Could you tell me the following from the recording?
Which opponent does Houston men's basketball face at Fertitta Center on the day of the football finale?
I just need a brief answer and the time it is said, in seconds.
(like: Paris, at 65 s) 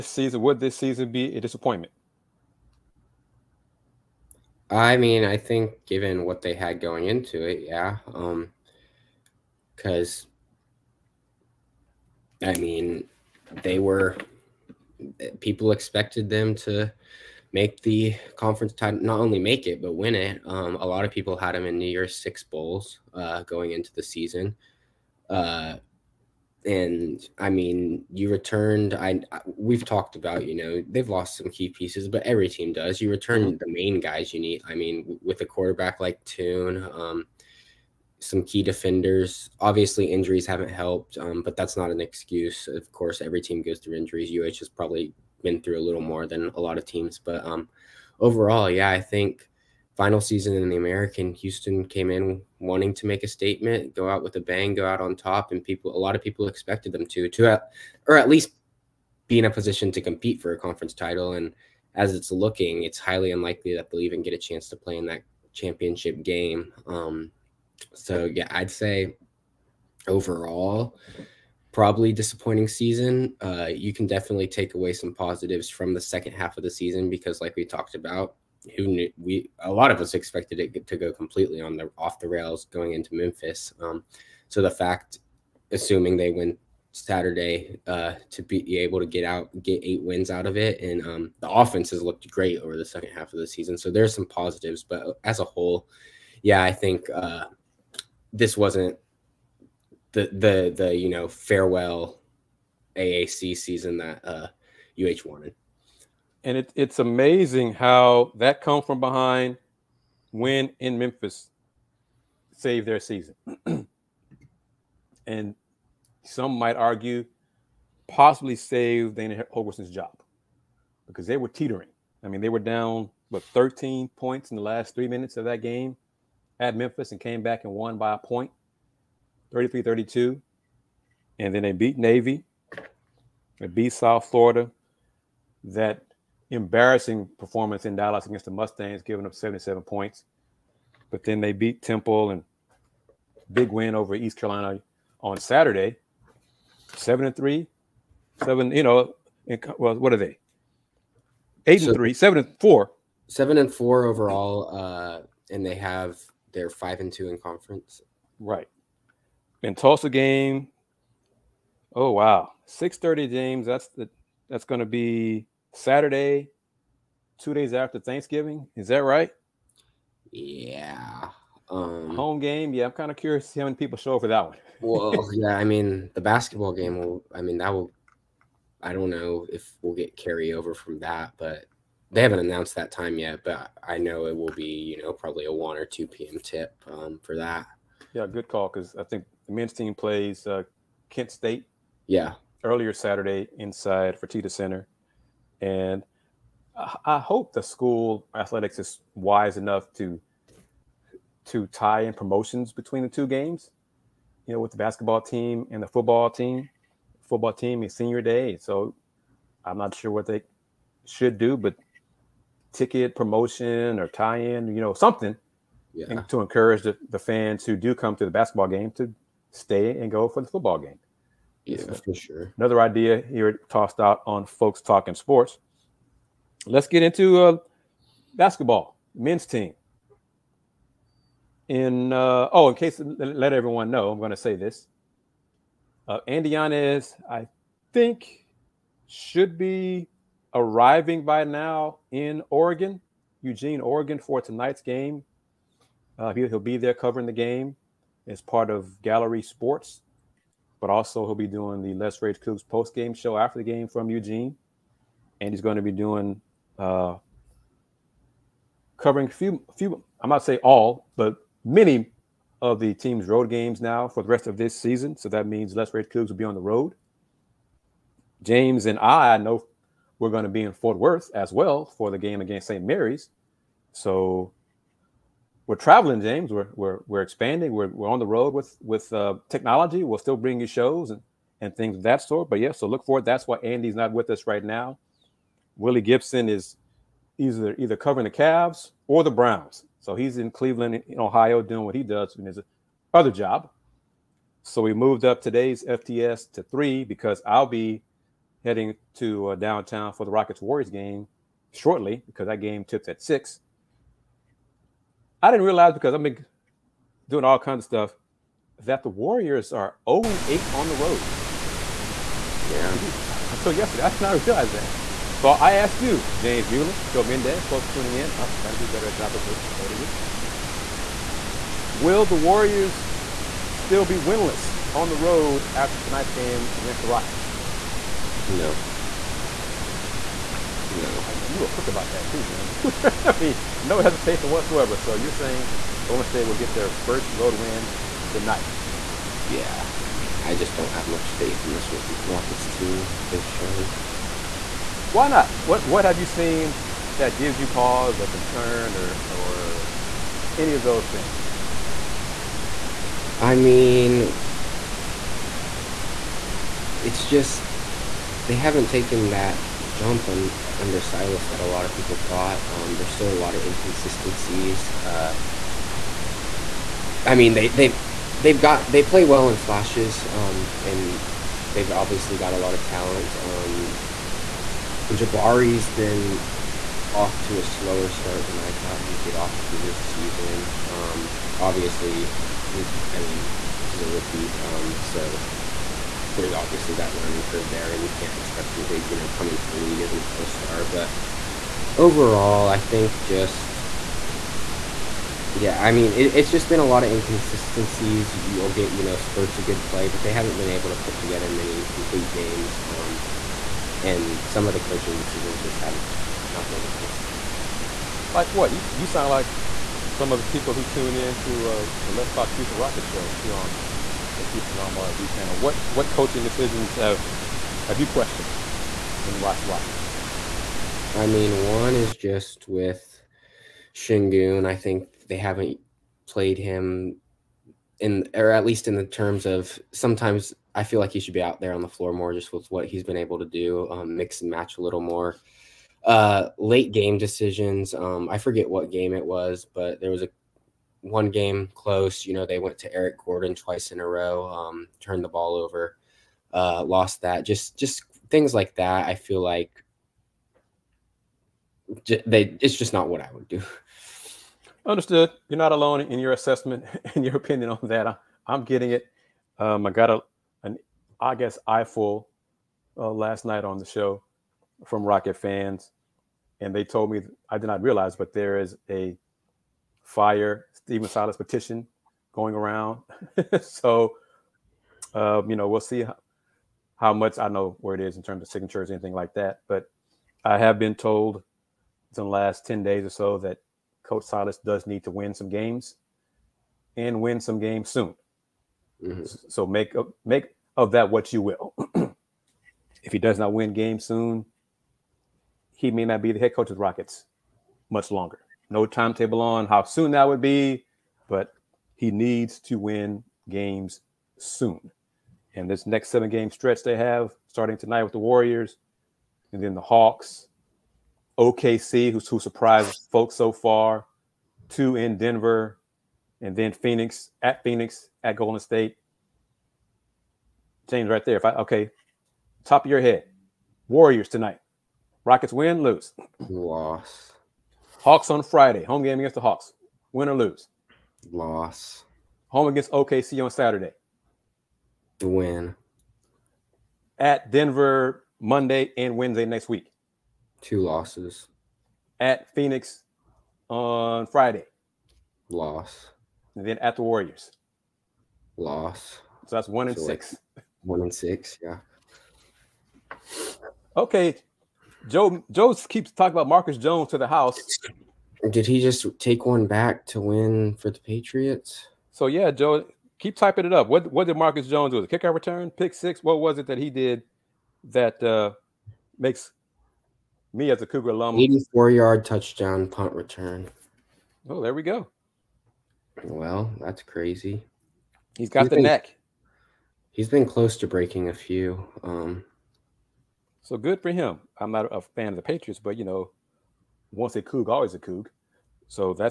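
Kent State, at 191 s.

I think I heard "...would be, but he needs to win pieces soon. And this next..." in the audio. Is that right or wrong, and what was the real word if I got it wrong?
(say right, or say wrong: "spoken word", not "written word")
wrong: "games", not "pieces".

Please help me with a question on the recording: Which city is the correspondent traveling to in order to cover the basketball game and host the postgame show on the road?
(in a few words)
Eugene, Oregon.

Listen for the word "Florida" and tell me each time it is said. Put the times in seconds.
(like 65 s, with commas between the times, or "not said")
134 s.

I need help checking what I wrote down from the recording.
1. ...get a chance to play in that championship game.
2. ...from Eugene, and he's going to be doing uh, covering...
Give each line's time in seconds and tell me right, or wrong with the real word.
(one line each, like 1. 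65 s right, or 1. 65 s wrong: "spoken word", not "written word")
1. 64 s right
2. 253 s right.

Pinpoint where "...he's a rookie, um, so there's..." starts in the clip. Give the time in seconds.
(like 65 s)
383 s.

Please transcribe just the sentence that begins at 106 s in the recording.
And it, it's amazing how that come from behind win in Memphis saved their season.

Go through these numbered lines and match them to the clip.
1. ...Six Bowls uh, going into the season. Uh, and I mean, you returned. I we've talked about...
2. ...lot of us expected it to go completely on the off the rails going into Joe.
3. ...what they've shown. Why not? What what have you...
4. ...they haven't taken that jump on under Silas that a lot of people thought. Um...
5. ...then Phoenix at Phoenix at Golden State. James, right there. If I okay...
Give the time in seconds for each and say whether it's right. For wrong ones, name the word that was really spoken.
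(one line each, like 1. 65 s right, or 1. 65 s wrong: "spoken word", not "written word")
1. 22 s right
2. 79 s wrong: "Memphis", not "Joe"
3. 343 s right
4. 358 s right
5. 516 s right.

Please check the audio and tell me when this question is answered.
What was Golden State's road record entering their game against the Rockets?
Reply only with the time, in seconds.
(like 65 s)
310 s.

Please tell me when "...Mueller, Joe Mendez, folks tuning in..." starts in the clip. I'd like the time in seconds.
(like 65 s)
316 s.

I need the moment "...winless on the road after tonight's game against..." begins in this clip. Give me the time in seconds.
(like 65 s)
324 s.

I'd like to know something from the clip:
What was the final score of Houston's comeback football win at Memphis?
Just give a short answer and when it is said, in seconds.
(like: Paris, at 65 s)
33-32, at 129 s.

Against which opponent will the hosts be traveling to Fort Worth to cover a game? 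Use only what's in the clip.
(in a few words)
St. Mary's.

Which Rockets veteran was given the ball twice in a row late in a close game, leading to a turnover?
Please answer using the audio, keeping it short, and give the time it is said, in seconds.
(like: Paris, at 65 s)
Eric Gordon, at 442 s.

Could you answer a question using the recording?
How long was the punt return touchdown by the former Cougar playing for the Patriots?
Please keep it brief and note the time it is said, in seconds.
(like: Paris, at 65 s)
84 yards, at 571 s.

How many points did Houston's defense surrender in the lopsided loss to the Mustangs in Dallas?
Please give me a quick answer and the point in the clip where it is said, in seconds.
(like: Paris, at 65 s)
77, at 139 s.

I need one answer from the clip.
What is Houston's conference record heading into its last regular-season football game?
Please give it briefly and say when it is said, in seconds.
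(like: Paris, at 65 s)
5-2, at 156 s.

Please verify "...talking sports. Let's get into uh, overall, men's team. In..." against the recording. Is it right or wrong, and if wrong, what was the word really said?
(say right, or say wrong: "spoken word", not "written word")
wrong: "basketball", not "overall".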